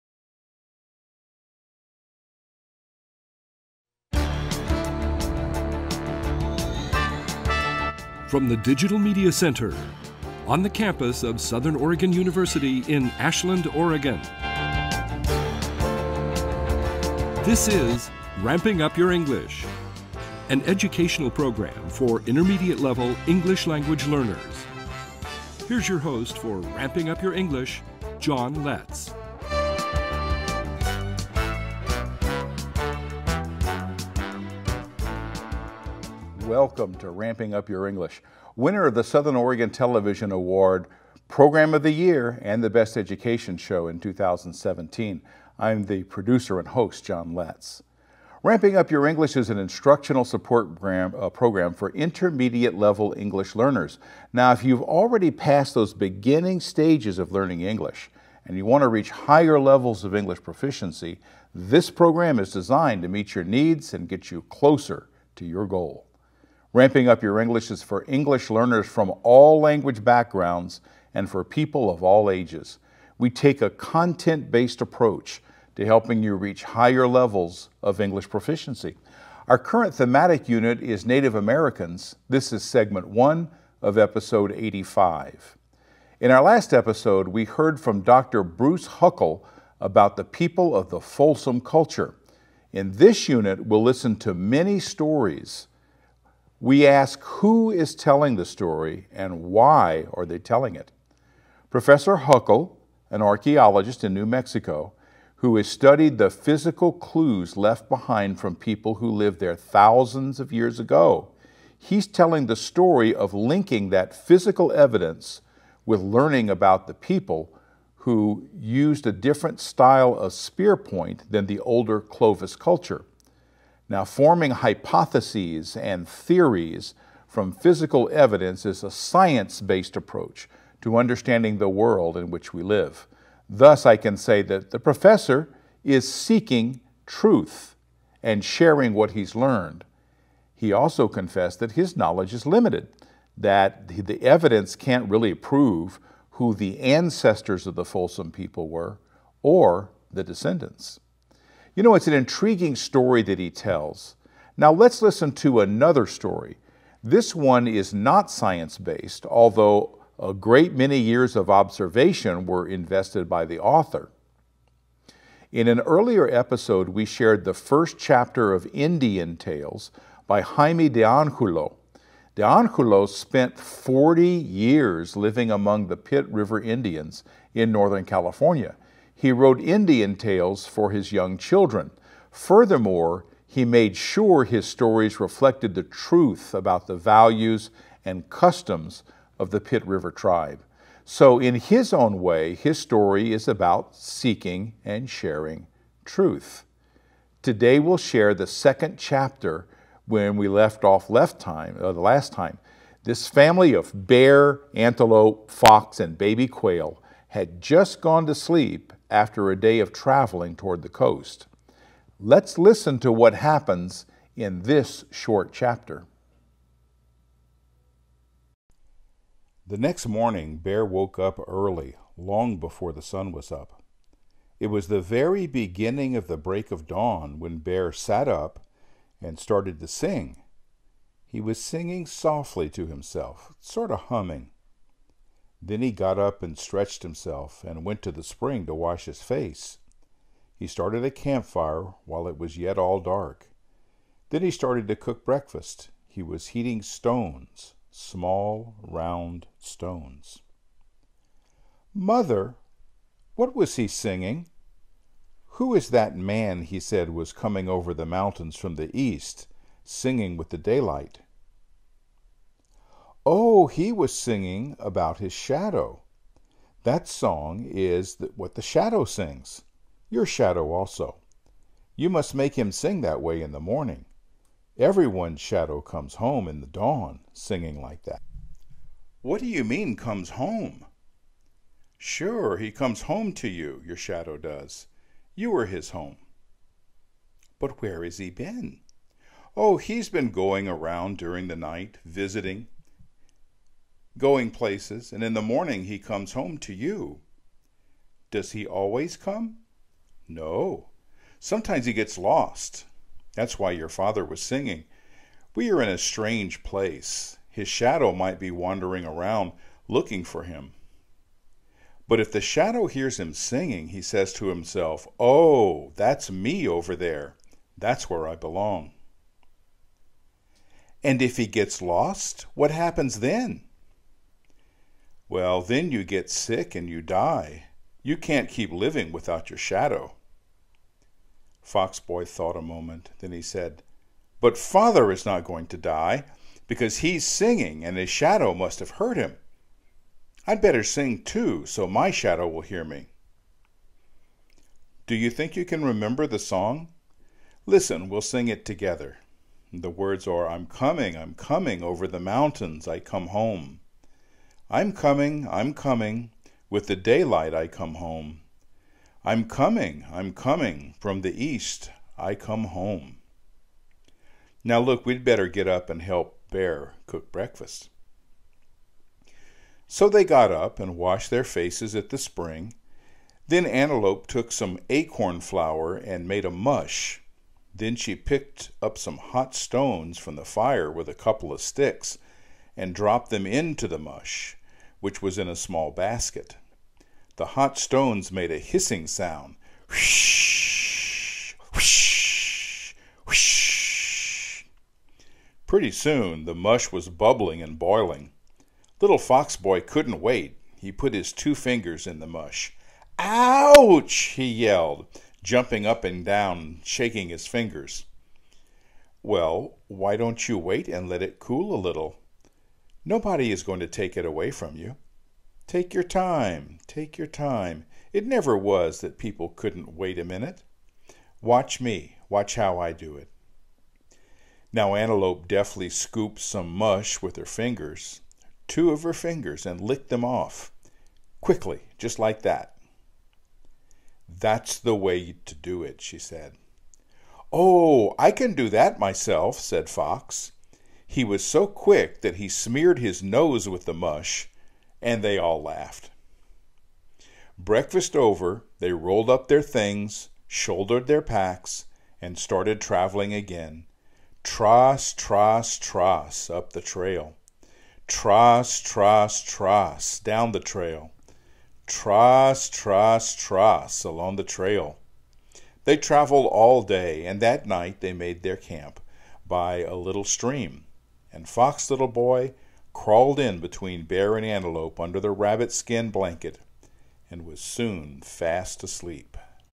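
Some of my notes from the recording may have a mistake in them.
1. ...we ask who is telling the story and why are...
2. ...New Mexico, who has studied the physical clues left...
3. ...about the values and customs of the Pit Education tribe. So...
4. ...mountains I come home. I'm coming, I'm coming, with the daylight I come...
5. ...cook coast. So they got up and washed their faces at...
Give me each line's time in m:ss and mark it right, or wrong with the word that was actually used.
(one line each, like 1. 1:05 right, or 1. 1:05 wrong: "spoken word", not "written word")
1. 1:36 right
2. 1:44 right
3. 3:06 wrong: "River", not "Education"
4. 5:52 right
5. 6:07 wrong: "breakfast", not "coast".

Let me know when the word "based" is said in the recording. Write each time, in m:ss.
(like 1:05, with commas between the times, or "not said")
1:14, 2:09, 2:38.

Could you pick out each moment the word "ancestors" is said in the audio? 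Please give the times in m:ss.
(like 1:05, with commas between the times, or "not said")
2:26.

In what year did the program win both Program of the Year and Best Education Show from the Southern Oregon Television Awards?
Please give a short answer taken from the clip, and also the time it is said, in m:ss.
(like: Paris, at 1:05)
2017, at 0:44.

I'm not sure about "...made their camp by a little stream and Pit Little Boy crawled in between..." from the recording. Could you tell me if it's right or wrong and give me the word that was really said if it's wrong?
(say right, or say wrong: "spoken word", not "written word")
wrong: "Fox", not "Pit".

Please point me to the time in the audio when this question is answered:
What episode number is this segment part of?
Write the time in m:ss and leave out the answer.
1:23.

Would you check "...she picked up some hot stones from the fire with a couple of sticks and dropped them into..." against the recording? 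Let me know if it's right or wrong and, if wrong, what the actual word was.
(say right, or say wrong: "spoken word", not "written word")
right.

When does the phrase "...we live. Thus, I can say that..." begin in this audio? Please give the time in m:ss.
2:12.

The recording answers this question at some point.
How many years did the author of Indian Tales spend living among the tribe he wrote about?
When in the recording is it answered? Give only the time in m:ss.
2:53.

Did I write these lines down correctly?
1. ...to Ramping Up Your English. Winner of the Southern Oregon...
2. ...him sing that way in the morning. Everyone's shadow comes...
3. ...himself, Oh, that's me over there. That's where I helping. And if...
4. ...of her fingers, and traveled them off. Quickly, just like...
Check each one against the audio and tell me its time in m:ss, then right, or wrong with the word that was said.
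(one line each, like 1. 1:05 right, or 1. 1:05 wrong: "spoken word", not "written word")
1. 0:36 right
2. 4:32 right
3. 5:14 wrong: "belong", not "helping"
4. 7:08 wrong: "licked", not "traveled".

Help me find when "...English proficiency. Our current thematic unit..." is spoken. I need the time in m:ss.
1:17.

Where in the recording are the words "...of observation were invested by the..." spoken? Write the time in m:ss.
2:41.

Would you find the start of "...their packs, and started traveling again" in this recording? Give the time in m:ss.
7:31.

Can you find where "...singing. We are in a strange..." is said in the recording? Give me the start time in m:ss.
5:04.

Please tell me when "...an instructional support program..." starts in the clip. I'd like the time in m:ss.
0:49.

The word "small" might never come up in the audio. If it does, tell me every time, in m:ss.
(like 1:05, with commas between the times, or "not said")
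4:07, 6:25.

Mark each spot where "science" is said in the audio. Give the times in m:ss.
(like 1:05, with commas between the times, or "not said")
2:08, 2:38.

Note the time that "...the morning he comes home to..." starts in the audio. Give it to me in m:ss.
4:55.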